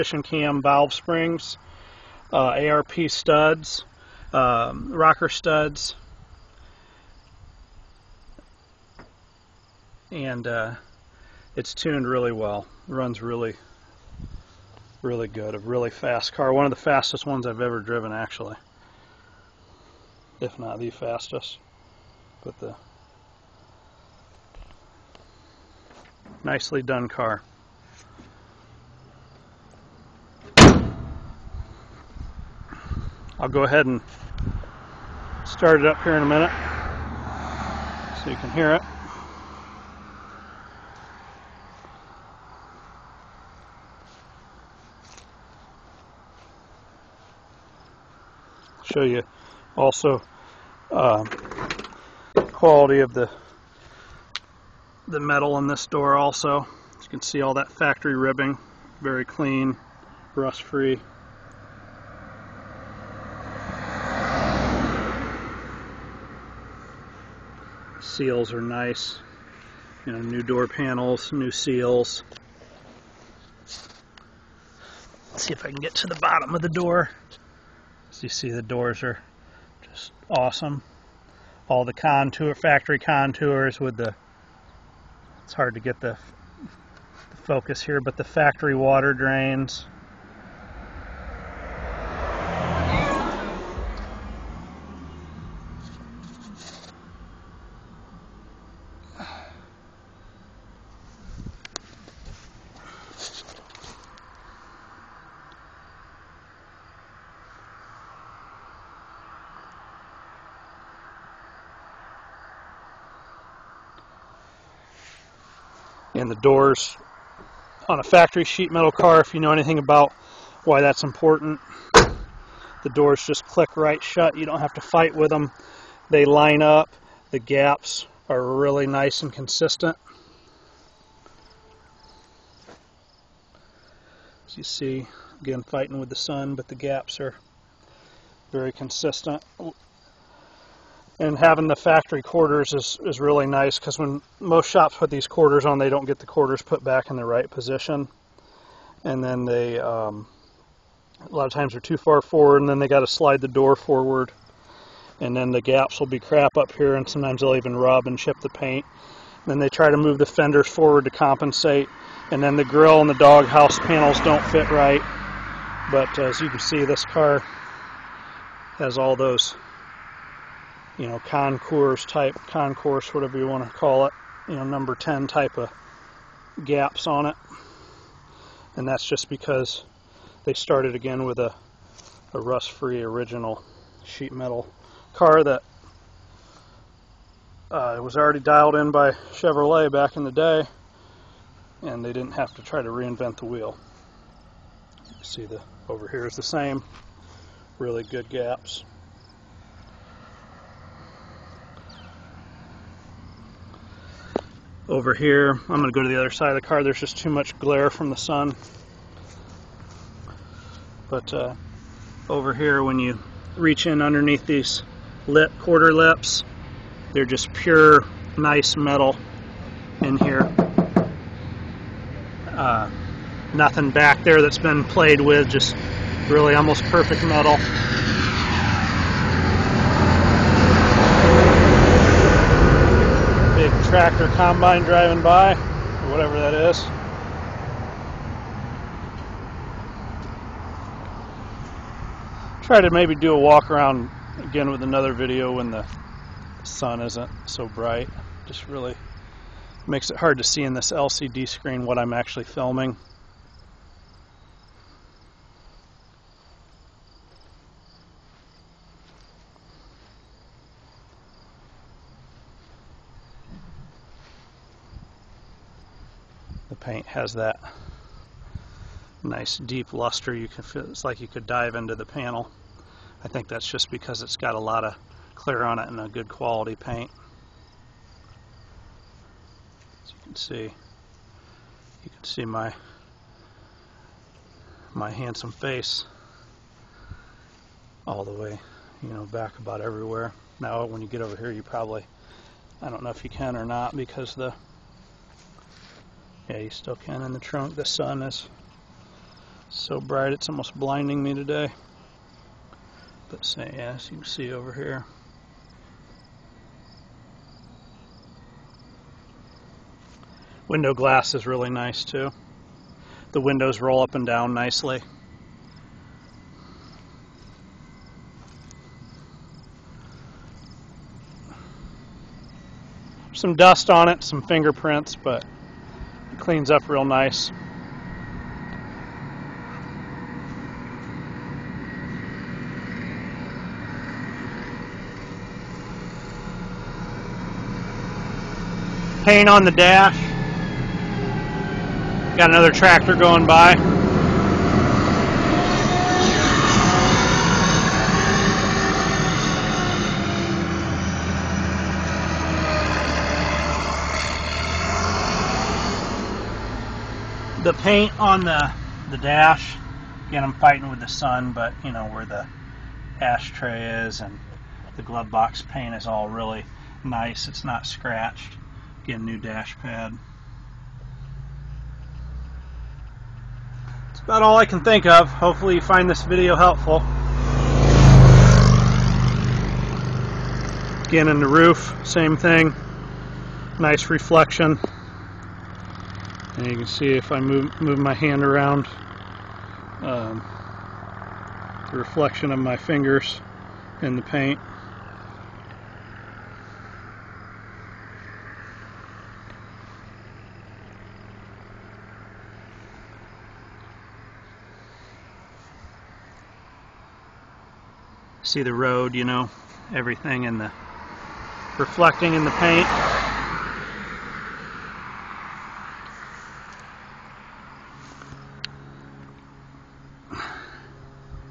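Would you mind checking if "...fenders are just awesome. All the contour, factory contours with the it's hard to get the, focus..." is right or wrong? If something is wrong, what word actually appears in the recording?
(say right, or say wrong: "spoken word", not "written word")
wrong: "doors", not "fenders".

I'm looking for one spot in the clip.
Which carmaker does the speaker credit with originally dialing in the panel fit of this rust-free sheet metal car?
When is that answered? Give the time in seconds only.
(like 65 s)
189 s.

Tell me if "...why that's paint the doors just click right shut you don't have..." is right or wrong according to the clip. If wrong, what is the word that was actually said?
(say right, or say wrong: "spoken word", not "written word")
wrong: "important", not "paint".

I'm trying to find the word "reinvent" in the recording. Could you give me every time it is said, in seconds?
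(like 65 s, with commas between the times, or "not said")
192 s.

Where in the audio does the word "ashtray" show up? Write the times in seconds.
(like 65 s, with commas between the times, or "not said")
363 s.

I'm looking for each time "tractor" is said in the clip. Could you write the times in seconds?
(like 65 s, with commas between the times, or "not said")
233 s, 342 s.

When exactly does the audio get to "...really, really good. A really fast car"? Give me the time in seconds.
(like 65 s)
13 s.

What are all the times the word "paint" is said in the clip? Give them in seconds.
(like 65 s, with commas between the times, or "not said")
158 s, 266 s, 276 s, 339 s, 357 s, 365 s, 394 s, 412 s.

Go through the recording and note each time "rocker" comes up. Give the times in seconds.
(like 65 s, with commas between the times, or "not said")
4 s.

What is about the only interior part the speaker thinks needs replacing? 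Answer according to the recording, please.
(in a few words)
dash pad.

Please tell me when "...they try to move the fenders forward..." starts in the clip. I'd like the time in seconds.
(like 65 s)
159 s.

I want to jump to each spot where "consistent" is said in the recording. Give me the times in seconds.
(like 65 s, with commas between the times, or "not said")
129 s, 138 s.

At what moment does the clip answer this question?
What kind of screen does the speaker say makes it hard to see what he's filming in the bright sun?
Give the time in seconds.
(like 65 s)
250 s.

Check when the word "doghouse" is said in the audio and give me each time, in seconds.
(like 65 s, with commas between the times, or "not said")
163 s.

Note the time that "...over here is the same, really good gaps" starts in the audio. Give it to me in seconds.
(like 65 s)
195 s.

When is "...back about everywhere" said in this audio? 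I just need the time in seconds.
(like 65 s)
289 s.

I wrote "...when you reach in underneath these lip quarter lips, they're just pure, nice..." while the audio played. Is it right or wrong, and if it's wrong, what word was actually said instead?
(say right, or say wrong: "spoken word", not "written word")
right.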